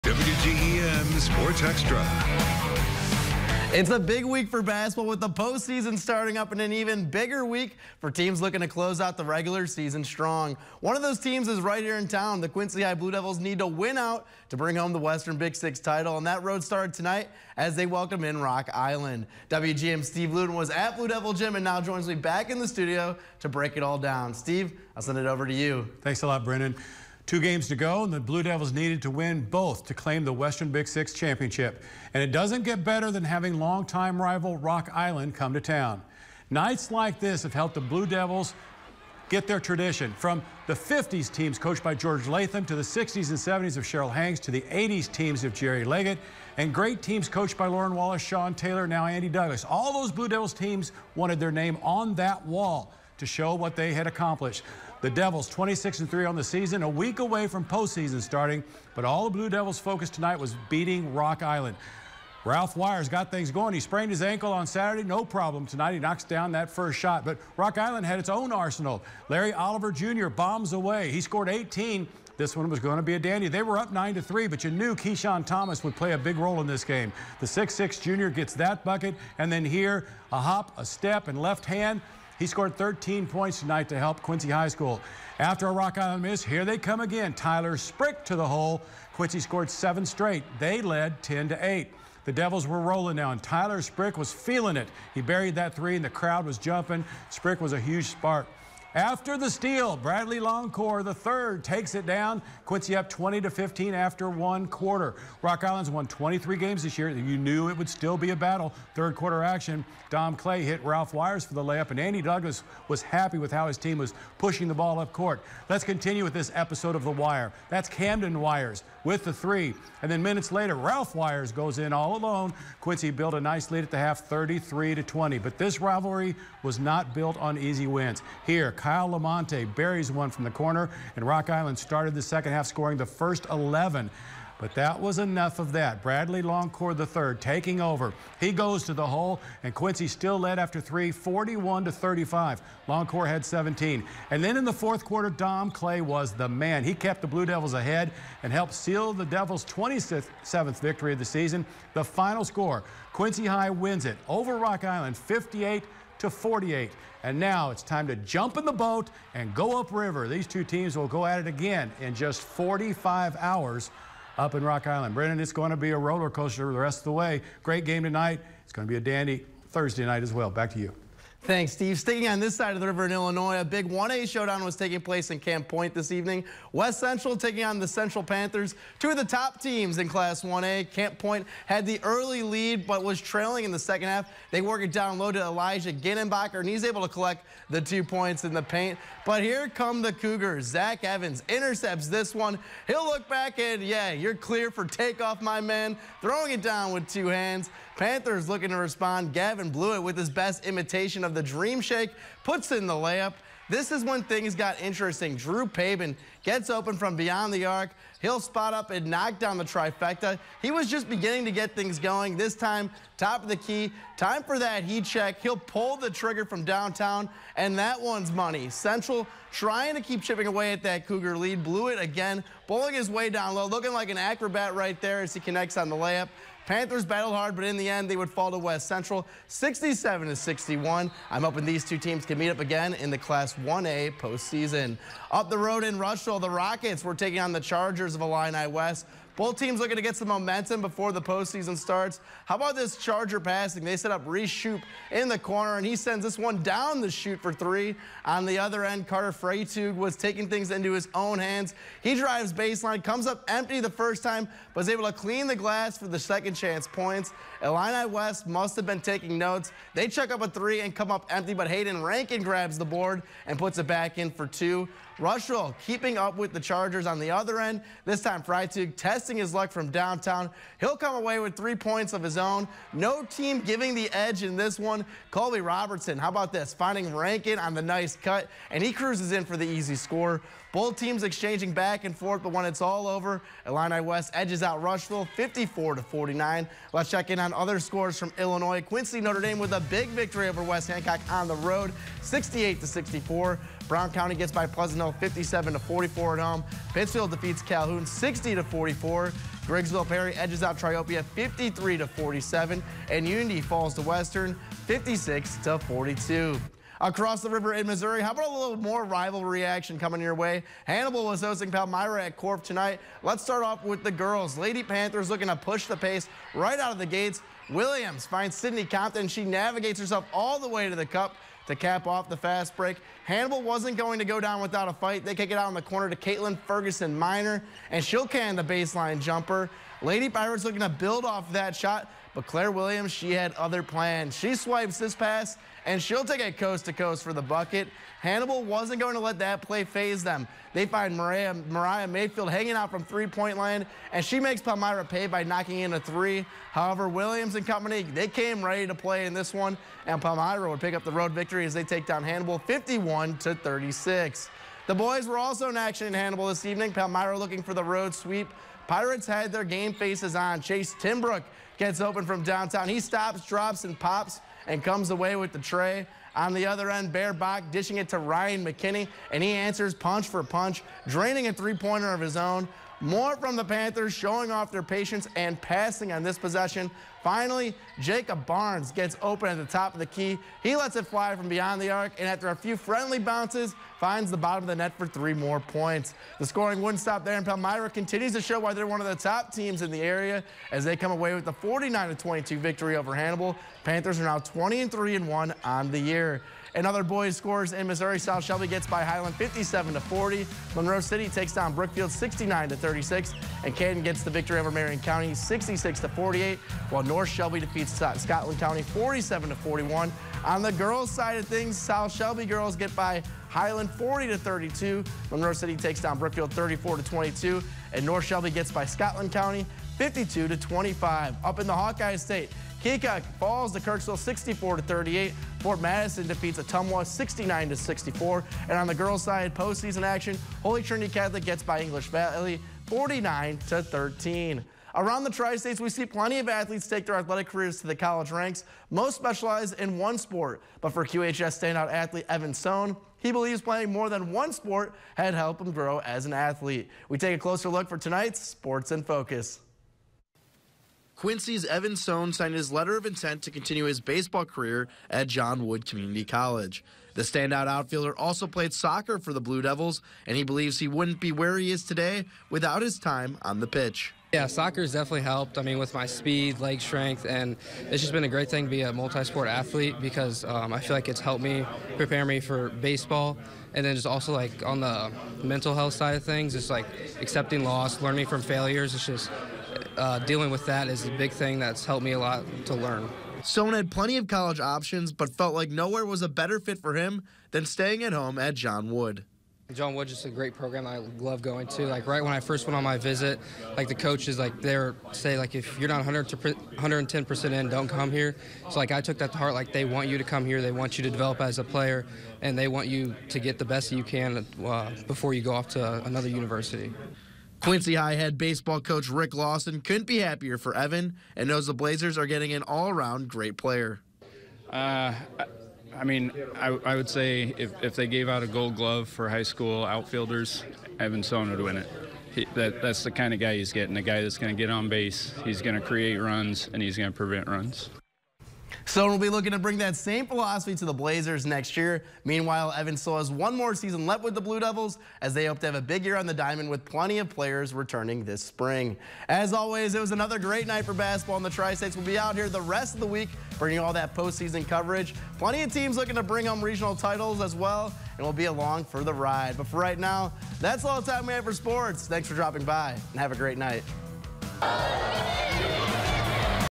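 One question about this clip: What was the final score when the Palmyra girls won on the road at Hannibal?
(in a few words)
51 to 36.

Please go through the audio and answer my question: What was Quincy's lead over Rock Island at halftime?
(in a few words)
33 to 20.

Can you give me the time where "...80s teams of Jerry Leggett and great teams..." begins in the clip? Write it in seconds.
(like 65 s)
44 s.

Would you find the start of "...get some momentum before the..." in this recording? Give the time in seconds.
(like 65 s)
240 s.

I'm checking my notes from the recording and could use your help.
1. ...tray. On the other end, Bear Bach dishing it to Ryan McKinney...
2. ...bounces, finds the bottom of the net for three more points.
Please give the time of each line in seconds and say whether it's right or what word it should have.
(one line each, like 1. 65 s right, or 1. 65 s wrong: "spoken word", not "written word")
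1. 365 s right
2. 383 s right.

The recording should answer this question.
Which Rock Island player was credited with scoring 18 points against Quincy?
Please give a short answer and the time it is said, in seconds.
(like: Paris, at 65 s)
Larry Oliver Jr., at 69 s.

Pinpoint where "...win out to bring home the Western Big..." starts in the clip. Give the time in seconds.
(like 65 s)
13 s.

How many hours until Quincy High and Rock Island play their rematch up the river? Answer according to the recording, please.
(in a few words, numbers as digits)
45.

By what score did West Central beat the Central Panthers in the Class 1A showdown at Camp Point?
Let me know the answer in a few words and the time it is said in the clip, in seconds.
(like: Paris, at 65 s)
67 to 61, at 229 s.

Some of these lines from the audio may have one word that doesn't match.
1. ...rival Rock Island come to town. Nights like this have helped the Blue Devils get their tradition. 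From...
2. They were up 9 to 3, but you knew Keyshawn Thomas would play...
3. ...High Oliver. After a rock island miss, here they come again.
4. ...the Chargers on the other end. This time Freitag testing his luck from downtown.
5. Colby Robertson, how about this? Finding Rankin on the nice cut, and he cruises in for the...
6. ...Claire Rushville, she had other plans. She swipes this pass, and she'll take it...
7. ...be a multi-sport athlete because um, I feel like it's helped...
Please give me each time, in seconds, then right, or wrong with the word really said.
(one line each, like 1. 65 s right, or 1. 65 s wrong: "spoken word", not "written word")
1. 34 s right
2. 73 s right
3. 84 s wrong: "School", not "Oliver"
4. 266 s right
5. 275 s right
6. 332 s wrong: "Williams", not "Rushville"
7. 468 s right.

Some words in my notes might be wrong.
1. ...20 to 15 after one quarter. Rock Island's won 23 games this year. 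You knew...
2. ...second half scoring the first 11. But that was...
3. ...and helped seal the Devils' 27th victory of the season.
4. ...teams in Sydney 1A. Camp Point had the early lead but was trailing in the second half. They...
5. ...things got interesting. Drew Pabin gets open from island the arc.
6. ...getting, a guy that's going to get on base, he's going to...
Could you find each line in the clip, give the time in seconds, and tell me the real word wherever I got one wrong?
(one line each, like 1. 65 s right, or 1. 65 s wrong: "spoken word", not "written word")
1. 103 s right
2. 132 s right
3. 148 s right
4. 179 s wrong: "Class", not "Sydney"
5. 204 s wrong: "beyond", not "island"
6. 523 s right.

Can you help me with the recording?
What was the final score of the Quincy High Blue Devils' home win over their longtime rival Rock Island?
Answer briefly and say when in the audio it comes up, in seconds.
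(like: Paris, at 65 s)
58 to 48, at 155 s.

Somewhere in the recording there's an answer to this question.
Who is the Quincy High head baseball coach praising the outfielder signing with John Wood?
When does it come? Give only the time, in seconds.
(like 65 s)
509 s.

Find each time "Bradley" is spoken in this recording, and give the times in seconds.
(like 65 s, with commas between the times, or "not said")
99 s, 136 s.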